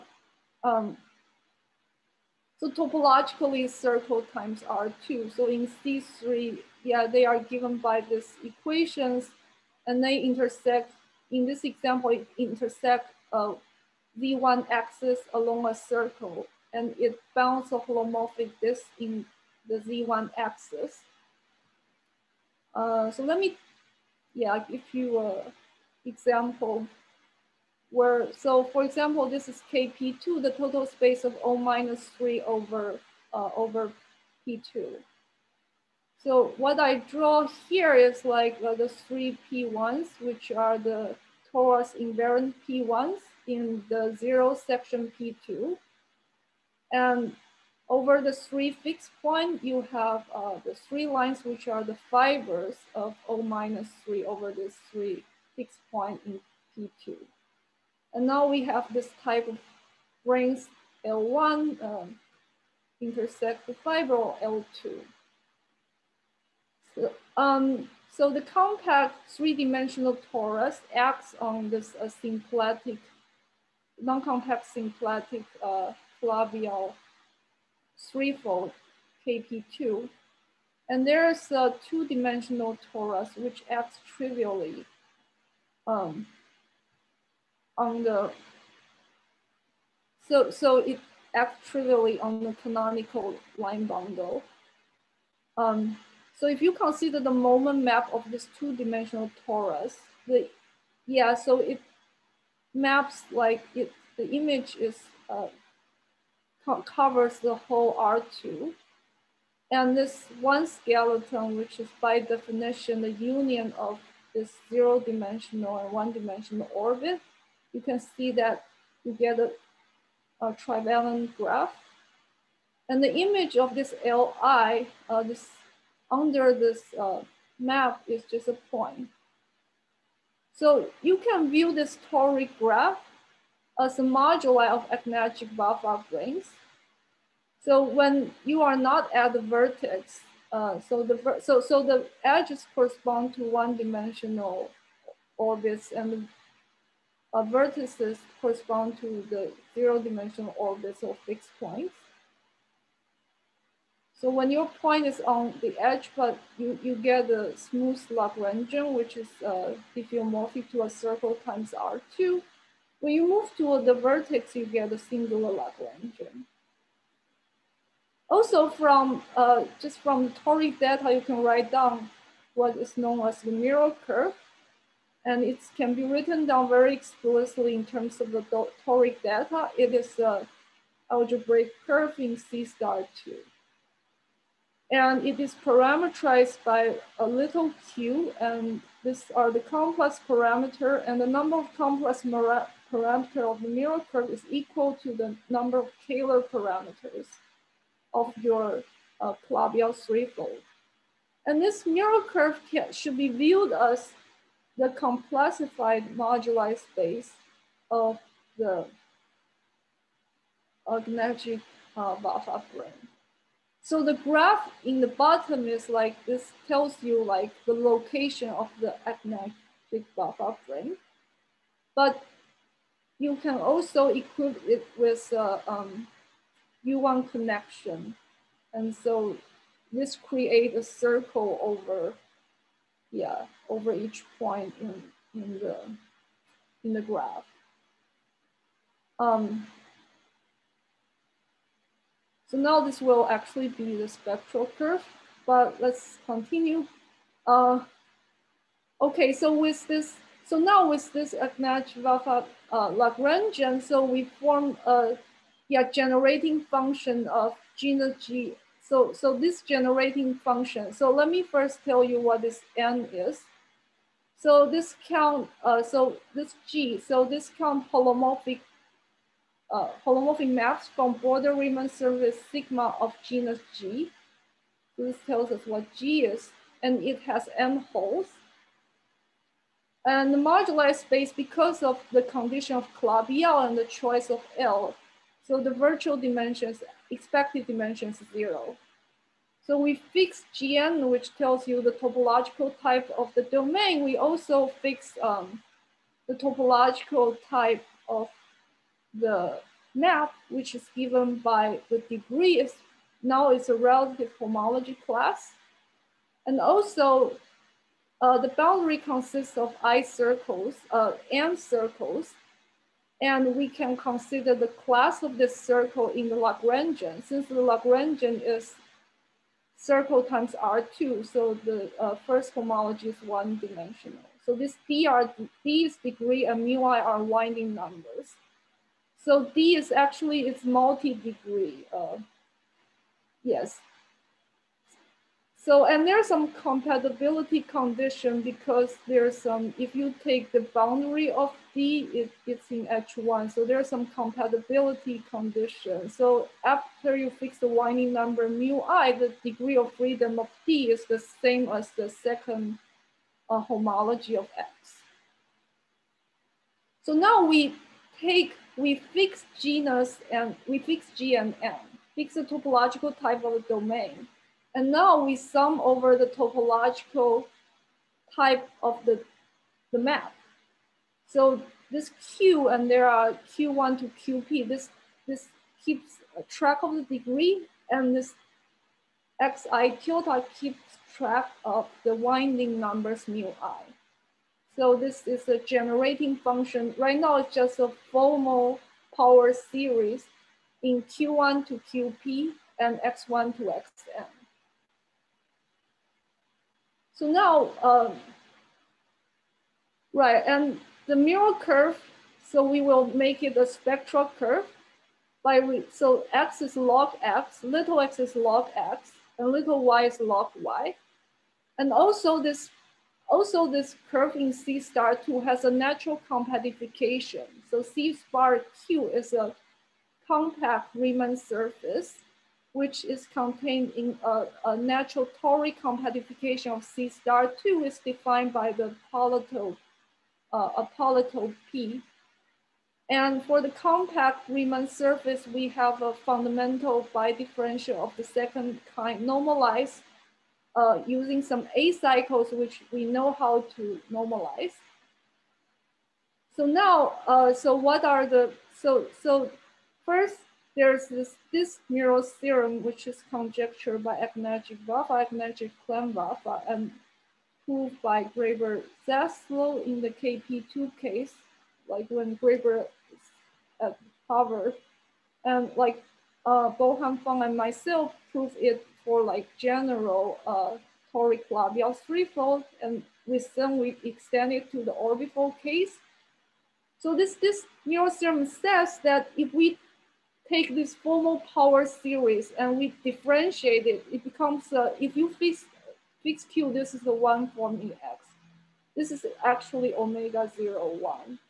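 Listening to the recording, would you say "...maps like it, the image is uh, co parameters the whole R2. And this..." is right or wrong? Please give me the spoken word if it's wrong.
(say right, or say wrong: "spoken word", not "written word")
wrong: "covers", not "parameters".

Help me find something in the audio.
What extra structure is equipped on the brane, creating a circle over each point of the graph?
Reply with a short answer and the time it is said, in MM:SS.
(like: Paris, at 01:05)
A U1 connection, at 03:46.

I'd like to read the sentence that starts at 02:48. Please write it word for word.
Also from, uh, just from toric data, you can write down what is known as the mirror curve.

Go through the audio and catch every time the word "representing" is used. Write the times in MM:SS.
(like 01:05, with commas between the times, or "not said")
not said.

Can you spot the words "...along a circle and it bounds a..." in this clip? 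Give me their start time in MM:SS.
00:15.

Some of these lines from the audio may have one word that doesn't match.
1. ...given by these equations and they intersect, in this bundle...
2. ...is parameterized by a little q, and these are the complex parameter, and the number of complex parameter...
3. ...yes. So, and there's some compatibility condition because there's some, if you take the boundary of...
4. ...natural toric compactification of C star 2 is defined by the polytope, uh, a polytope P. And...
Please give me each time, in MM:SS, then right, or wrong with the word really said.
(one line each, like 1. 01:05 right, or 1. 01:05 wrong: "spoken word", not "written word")
1. 00:07 wrong: "example", not "bundle"
2. 03:05 right
3. 05:33 right
4. 07:04 right.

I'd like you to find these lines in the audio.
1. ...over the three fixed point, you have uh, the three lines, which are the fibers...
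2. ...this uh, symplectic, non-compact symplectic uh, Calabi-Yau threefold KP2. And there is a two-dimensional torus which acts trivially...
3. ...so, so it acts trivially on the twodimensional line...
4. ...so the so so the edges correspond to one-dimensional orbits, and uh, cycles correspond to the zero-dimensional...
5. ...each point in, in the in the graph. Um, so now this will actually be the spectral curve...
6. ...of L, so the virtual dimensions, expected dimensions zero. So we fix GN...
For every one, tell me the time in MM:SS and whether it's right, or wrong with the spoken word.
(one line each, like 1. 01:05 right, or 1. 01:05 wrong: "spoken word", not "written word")
1. 00:47 right
2. 01:11 right
3. 01:30 wrong: "canonical", not "twodimensional"
4. 02:20 wrong: "vertices", not "cycles"
5. 03:53 right
6. 04:44 right.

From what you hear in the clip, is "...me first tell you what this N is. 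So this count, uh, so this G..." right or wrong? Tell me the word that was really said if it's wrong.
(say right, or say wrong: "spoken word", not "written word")
right.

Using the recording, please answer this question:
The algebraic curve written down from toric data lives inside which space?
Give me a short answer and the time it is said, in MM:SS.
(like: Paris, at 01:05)
C star two, at 03:02.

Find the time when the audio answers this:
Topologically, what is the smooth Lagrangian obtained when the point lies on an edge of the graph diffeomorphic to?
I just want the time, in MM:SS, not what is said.
02:40.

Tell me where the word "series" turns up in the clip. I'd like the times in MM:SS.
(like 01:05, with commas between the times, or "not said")
06:29, 08:01.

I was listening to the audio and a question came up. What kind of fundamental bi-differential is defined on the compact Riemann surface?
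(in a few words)
Of the second kind.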